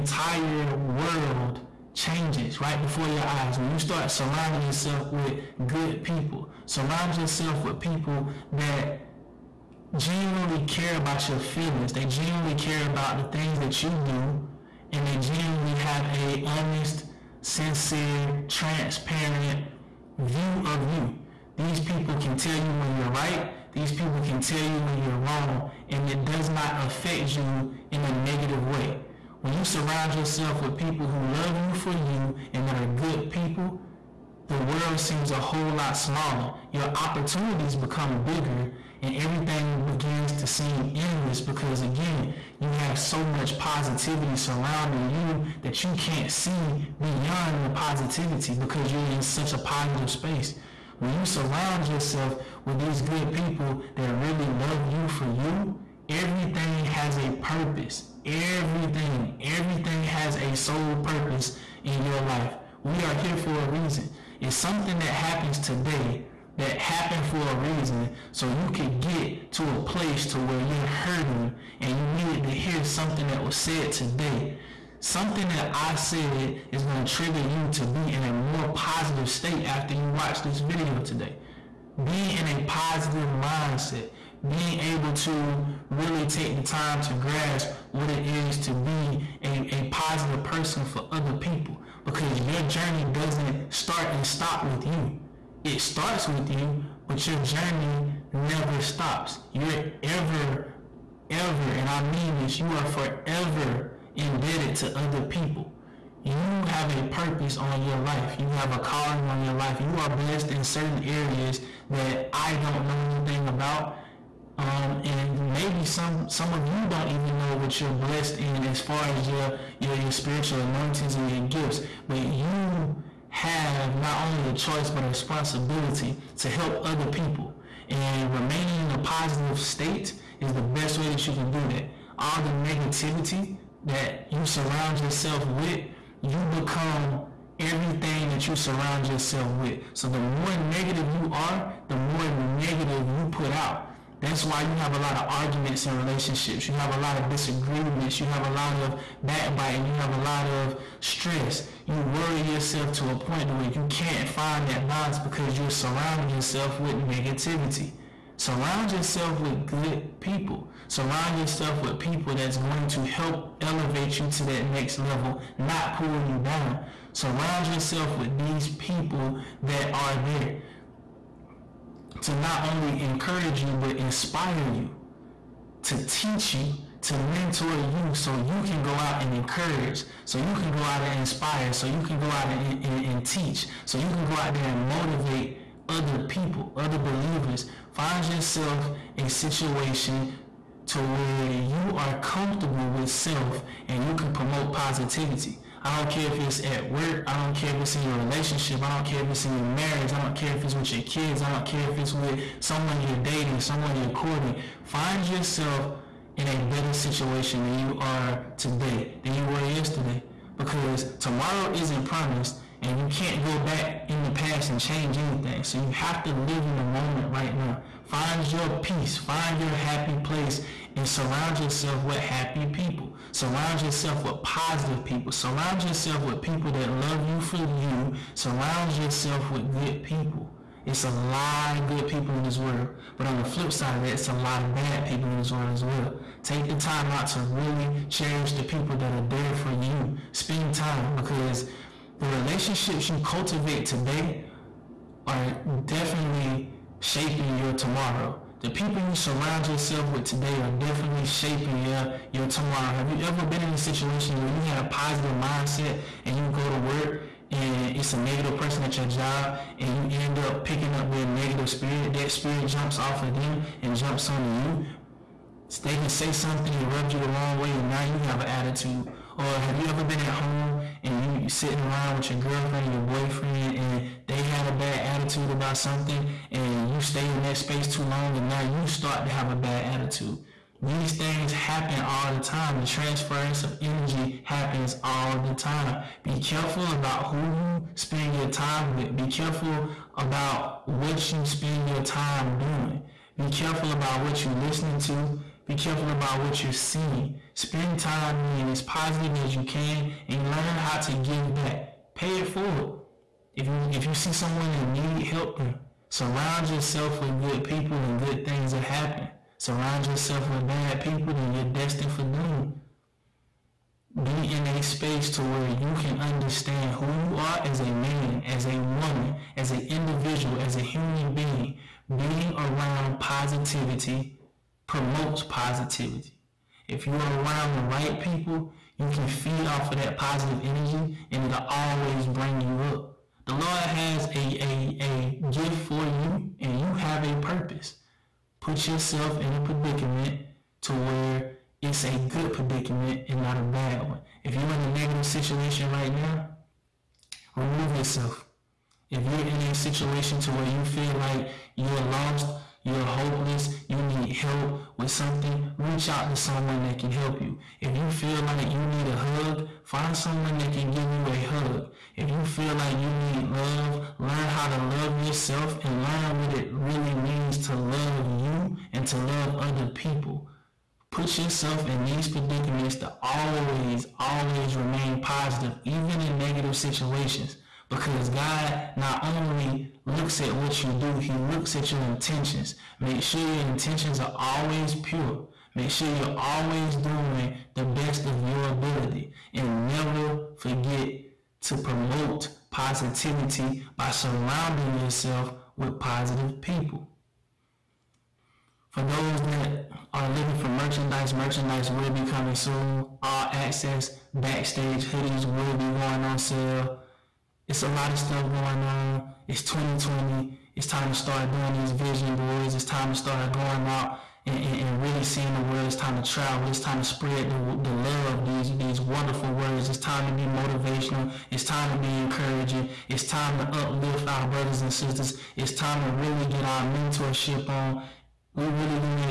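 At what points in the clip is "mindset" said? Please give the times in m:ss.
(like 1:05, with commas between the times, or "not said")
1:23, 4:15.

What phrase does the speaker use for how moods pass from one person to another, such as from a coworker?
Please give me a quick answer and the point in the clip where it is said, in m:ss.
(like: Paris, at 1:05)
transference of energy, at 4:42.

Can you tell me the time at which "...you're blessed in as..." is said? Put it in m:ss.
1:57.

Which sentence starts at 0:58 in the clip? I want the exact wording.
Everything, everything has a sole purpose in your life.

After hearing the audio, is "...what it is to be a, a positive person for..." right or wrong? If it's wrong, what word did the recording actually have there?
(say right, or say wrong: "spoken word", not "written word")
right.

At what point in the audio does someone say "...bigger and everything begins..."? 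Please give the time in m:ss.
0:38.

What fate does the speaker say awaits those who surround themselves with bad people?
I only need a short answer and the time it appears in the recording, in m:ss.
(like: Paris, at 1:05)
doom, at 5:12.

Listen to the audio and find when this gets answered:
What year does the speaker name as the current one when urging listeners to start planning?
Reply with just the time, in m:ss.
6:49.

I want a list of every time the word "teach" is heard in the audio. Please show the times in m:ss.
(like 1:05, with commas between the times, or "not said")
2:56, 3:03.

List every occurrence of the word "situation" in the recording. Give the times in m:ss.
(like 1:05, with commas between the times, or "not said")
3:09, 3:26, 4:13, 5:45, 5:49, 6:16.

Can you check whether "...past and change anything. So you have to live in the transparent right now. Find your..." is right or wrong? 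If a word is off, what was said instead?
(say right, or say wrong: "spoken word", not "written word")
wrong: "moment", not "transparent".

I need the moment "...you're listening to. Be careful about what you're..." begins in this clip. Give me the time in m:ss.
4:54.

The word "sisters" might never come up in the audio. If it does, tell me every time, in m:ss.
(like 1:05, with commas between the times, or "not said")
7:04.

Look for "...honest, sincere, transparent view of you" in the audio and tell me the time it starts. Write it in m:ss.
0:16.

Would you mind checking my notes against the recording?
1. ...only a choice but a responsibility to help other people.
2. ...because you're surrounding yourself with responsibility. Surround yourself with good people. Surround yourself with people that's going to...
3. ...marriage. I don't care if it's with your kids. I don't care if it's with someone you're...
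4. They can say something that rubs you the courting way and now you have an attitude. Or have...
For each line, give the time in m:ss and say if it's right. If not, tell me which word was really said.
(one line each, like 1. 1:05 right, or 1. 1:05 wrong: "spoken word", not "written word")
1. 2:04 right
2. 2:35 wrong: "negativity", not "responsibility"
3. 3:19 right
4. 4:25 wrong: "wrong", not "courting".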